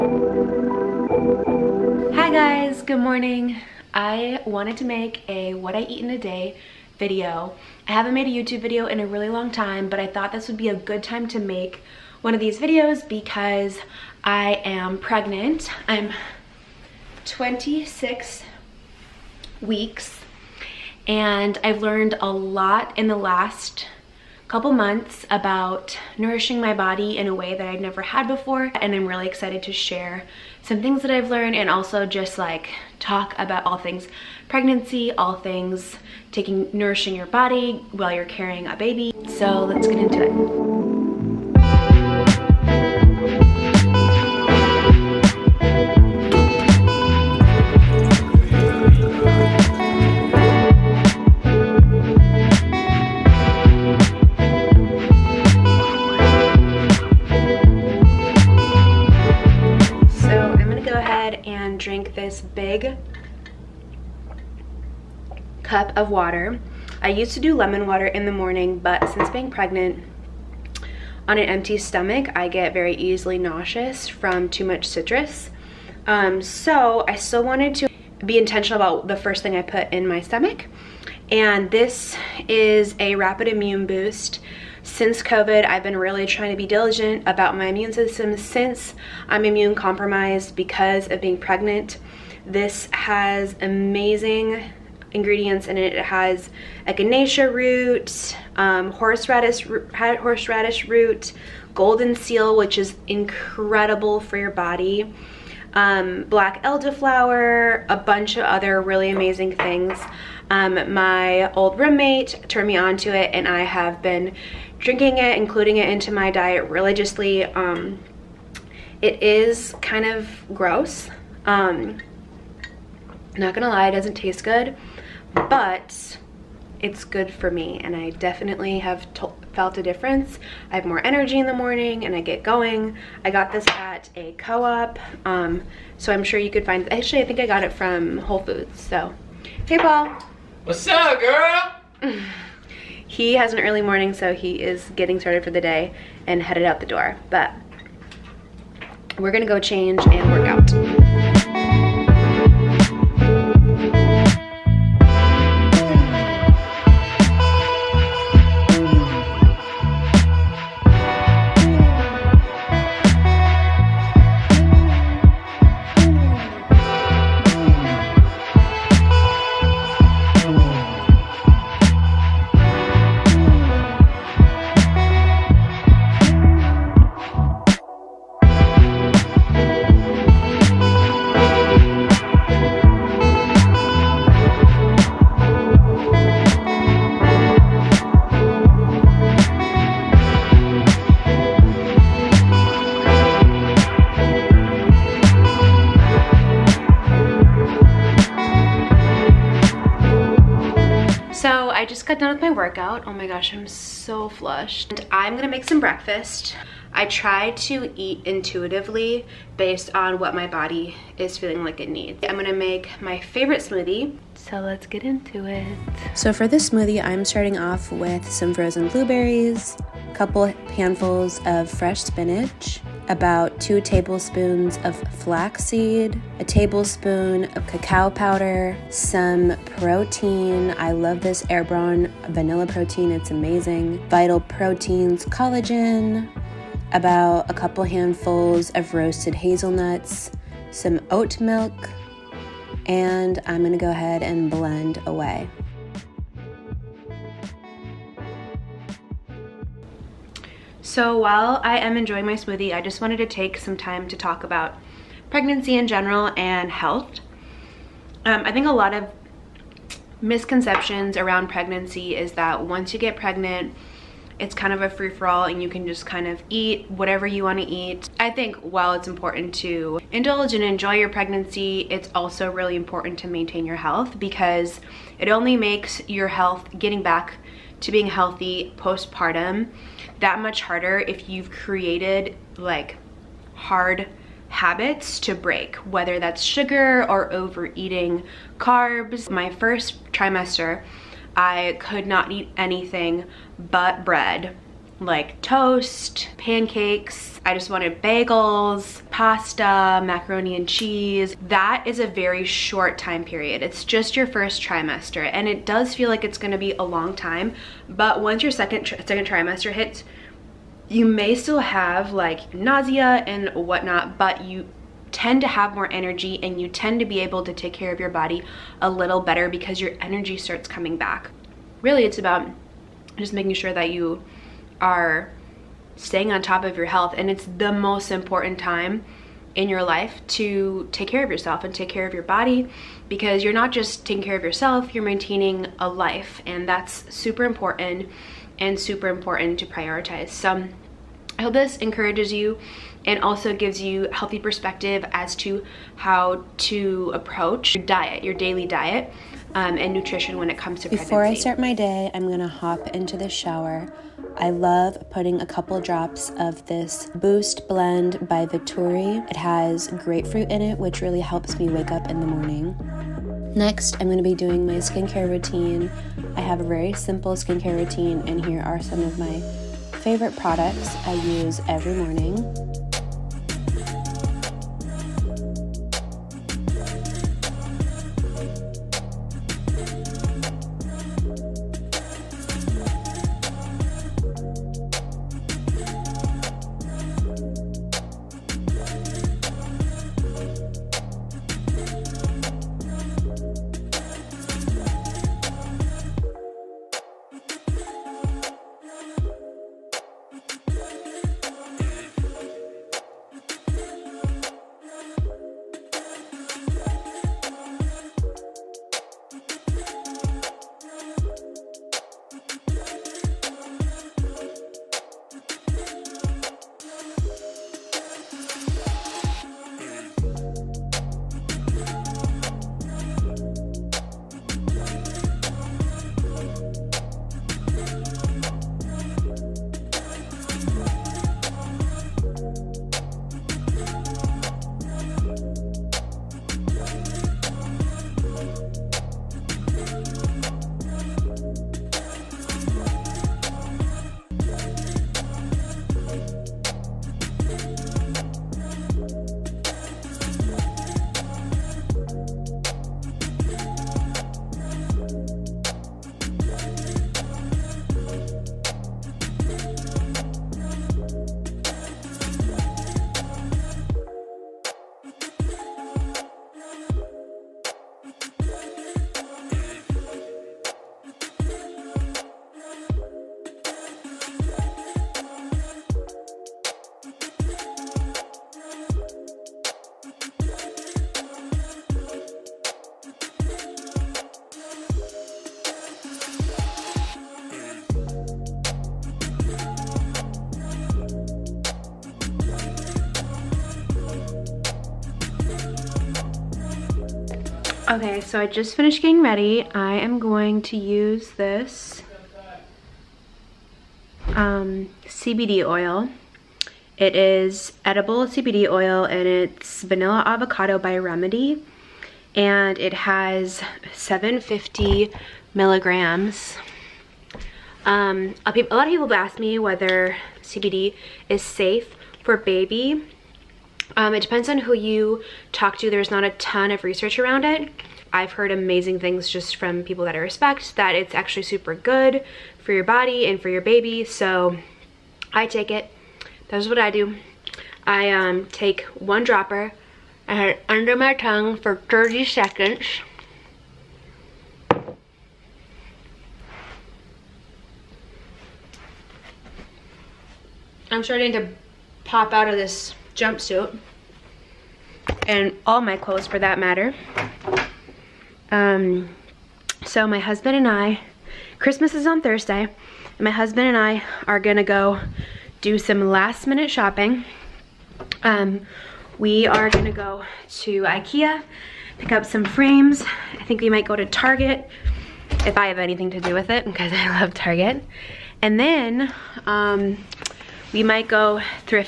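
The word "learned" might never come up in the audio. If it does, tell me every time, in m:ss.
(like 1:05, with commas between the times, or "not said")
0:21, 0:31.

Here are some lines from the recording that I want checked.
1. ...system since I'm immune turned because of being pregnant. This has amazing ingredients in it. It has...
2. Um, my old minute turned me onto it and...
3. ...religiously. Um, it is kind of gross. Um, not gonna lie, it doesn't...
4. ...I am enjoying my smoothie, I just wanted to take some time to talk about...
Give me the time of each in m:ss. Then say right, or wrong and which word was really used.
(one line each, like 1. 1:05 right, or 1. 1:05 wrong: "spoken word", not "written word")
1. 1:27 wrong: "compromised", not "turned"
2. 1:50 wrong: "roommate", not "minute"
3. 1:56 right
4. 4:11 right.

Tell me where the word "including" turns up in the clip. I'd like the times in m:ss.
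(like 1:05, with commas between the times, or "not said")
1:55.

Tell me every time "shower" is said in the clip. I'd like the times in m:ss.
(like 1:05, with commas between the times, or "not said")
5:53.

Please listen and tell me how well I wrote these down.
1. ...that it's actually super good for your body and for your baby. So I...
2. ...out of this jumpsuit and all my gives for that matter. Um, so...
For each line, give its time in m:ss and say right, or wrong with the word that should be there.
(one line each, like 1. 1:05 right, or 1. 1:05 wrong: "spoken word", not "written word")
1. 8:50 right
2. 9:12 wrong: "clothes", not "gives".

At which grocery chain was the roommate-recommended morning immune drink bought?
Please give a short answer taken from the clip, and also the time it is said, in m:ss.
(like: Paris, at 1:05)
Whole Foods, at 2:18.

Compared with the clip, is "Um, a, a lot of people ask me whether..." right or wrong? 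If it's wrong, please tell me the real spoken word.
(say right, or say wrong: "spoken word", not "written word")
right.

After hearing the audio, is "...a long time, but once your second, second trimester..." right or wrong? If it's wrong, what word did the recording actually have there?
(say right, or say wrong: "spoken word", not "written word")
right.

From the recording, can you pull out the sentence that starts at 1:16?
Um, so I still wanted to be intentional about the first thing I put in my stomach.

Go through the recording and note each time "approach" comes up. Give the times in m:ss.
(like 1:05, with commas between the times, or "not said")
5:47.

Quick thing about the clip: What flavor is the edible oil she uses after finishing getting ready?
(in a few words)
vanilla avocado.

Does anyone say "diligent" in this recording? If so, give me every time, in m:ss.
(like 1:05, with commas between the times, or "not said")
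1:26.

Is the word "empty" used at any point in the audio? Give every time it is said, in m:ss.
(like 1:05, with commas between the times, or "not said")
1:11.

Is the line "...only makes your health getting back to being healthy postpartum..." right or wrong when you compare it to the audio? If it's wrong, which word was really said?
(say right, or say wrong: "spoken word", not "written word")
right.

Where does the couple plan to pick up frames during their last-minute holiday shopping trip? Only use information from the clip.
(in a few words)
Ikea.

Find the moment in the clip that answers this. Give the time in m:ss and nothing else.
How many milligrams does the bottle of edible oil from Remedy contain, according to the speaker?
8:33.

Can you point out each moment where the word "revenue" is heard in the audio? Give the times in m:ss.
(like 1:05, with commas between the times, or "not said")
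not said.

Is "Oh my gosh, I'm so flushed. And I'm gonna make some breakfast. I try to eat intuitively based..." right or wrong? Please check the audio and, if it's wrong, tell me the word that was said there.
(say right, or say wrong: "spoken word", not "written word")
right.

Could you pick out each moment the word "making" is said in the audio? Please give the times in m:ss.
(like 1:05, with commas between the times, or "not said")
5:23.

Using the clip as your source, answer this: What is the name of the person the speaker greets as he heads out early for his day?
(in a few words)
Paul.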